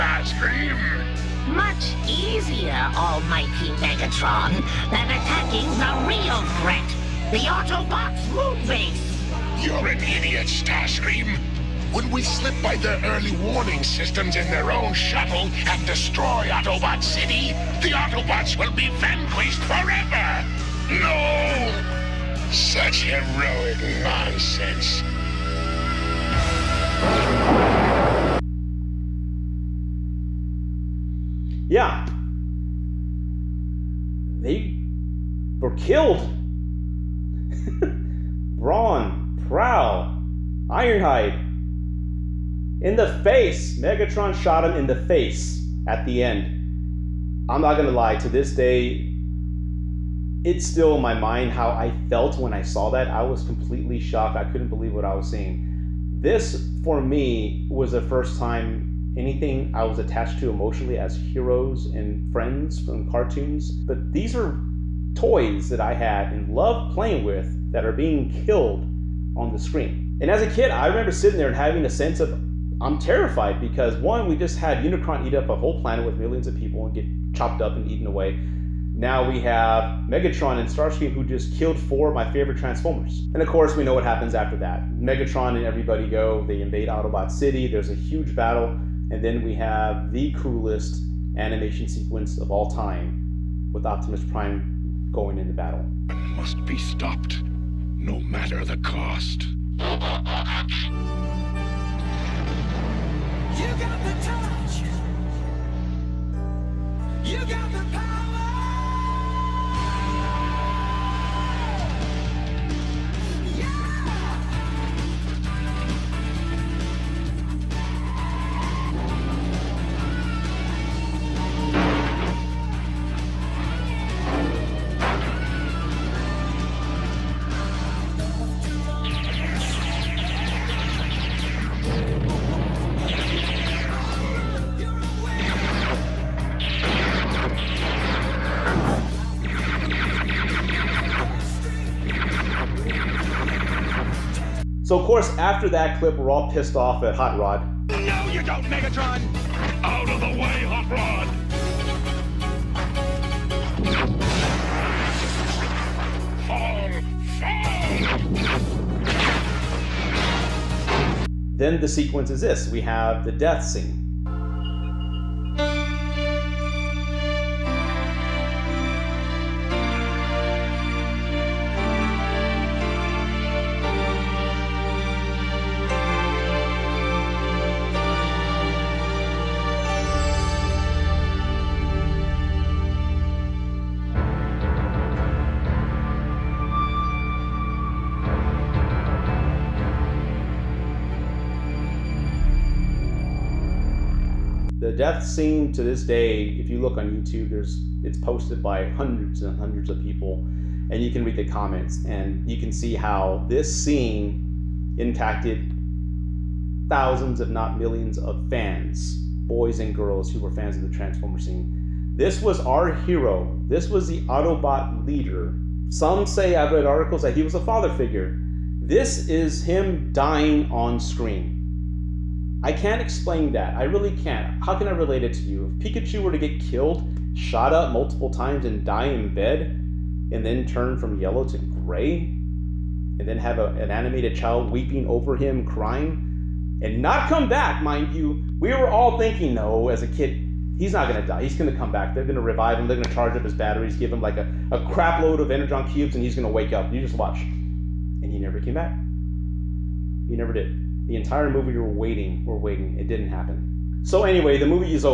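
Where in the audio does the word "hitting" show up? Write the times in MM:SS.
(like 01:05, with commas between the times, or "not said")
not said.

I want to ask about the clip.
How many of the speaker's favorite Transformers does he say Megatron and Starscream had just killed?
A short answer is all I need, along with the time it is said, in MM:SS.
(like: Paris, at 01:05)
4, at 01:21.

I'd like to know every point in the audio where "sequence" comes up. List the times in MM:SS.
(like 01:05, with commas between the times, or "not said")
01:31, 02:41.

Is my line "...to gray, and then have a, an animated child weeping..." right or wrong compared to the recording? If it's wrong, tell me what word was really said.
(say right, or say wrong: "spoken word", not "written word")
right.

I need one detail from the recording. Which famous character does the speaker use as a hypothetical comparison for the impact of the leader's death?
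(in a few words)
Pikachu.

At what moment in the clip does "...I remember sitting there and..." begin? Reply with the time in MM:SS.
01:10.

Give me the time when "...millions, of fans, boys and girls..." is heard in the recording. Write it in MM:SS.
03:27.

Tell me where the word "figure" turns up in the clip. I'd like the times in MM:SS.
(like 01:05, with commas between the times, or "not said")
03:37.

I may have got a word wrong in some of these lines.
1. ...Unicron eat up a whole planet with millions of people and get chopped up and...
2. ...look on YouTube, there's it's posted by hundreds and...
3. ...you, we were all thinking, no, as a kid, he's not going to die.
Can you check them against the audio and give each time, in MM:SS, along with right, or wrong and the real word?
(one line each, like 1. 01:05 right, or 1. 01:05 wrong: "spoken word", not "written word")
1. 01:14 right
2. 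03:16 right
3. 03:58 right.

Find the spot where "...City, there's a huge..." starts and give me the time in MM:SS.
01:27.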